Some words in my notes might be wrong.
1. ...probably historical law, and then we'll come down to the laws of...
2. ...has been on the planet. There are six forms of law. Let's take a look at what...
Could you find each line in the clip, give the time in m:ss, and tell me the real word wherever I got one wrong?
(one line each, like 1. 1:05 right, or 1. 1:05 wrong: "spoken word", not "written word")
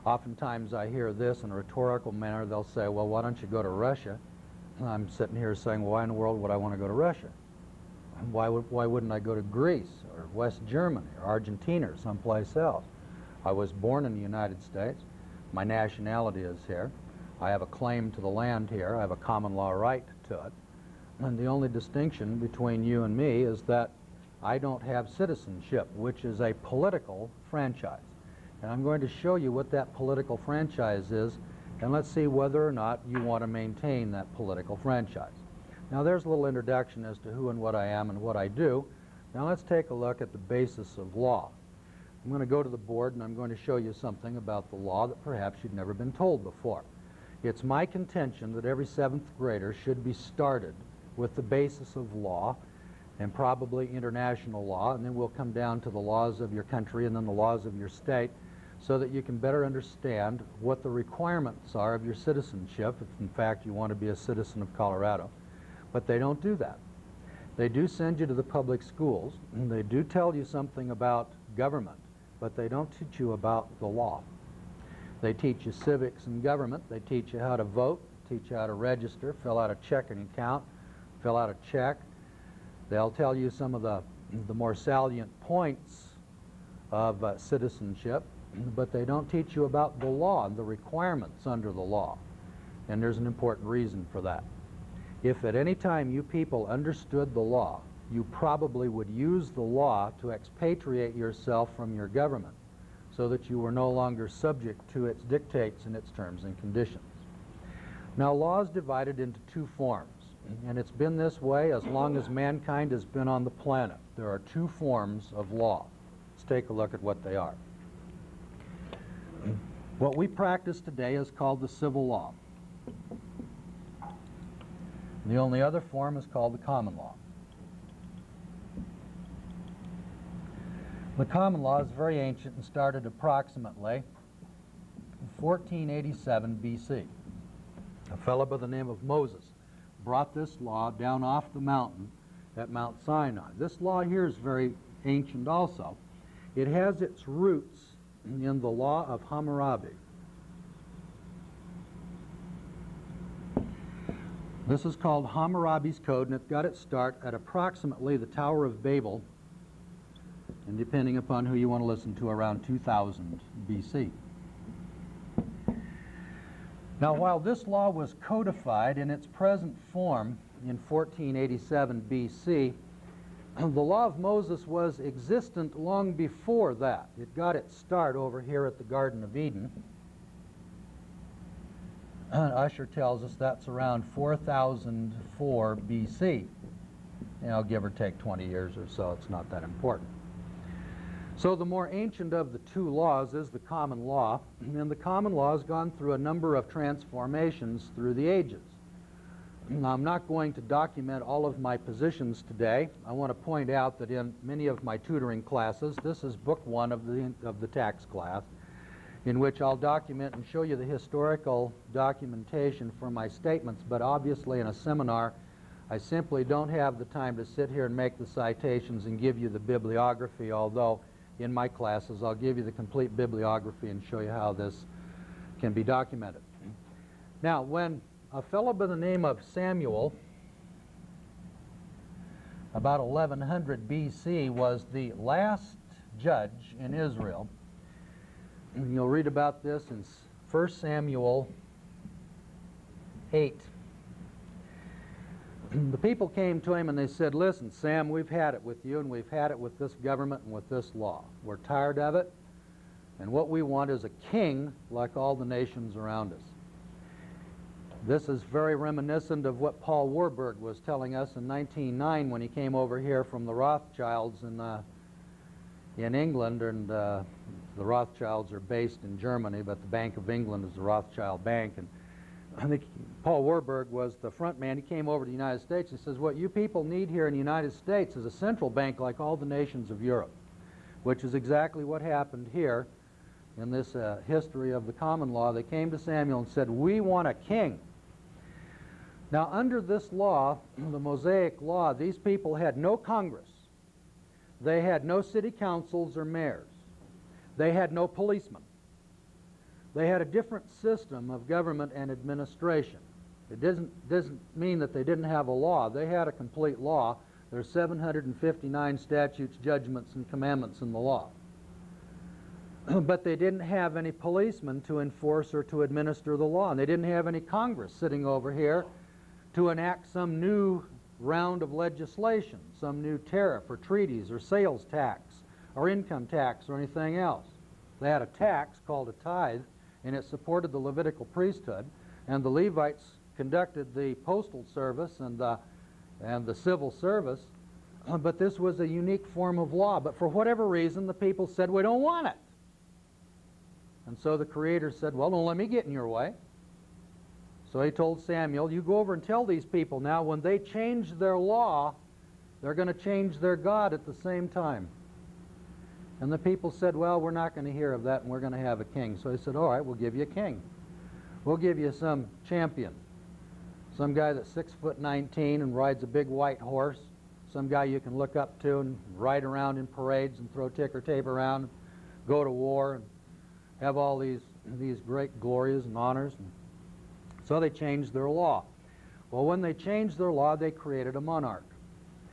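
1. 0:53 wrong: "international", not "historical"
2. 1:52 wrong: "two", not "six".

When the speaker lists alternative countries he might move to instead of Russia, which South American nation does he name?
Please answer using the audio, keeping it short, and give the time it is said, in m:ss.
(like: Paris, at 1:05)
Argentina, at 0:11.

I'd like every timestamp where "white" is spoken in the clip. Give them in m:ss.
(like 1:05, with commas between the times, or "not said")
6:06.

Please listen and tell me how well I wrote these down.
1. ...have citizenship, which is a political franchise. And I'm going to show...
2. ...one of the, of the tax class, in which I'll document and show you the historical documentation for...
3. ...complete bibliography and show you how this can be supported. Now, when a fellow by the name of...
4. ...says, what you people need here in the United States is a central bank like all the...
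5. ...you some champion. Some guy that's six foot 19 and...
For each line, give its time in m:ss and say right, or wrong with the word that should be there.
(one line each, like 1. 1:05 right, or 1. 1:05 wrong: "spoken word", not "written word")
1. 0:24 right
2. 3:26 right
3. 3:42 wrong: "documented", not "supported"
4. 4:35 right
5. 6:01 right.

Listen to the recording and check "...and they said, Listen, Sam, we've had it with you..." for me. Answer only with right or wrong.
right.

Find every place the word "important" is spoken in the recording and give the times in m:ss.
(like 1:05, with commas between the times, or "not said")
1:33, 3:09.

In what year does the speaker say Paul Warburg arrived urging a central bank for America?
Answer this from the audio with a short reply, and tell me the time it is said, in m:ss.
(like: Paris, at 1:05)
1909, at 4:21.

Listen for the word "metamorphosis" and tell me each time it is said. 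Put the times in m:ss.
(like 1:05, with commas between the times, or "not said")
not said.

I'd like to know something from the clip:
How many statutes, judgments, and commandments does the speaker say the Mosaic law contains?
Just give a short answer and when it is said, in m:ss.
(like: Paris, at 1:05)
759, at 5:07.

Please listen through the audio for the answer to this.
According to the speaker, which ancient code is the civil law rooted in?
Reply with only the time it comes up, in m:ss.
2:35.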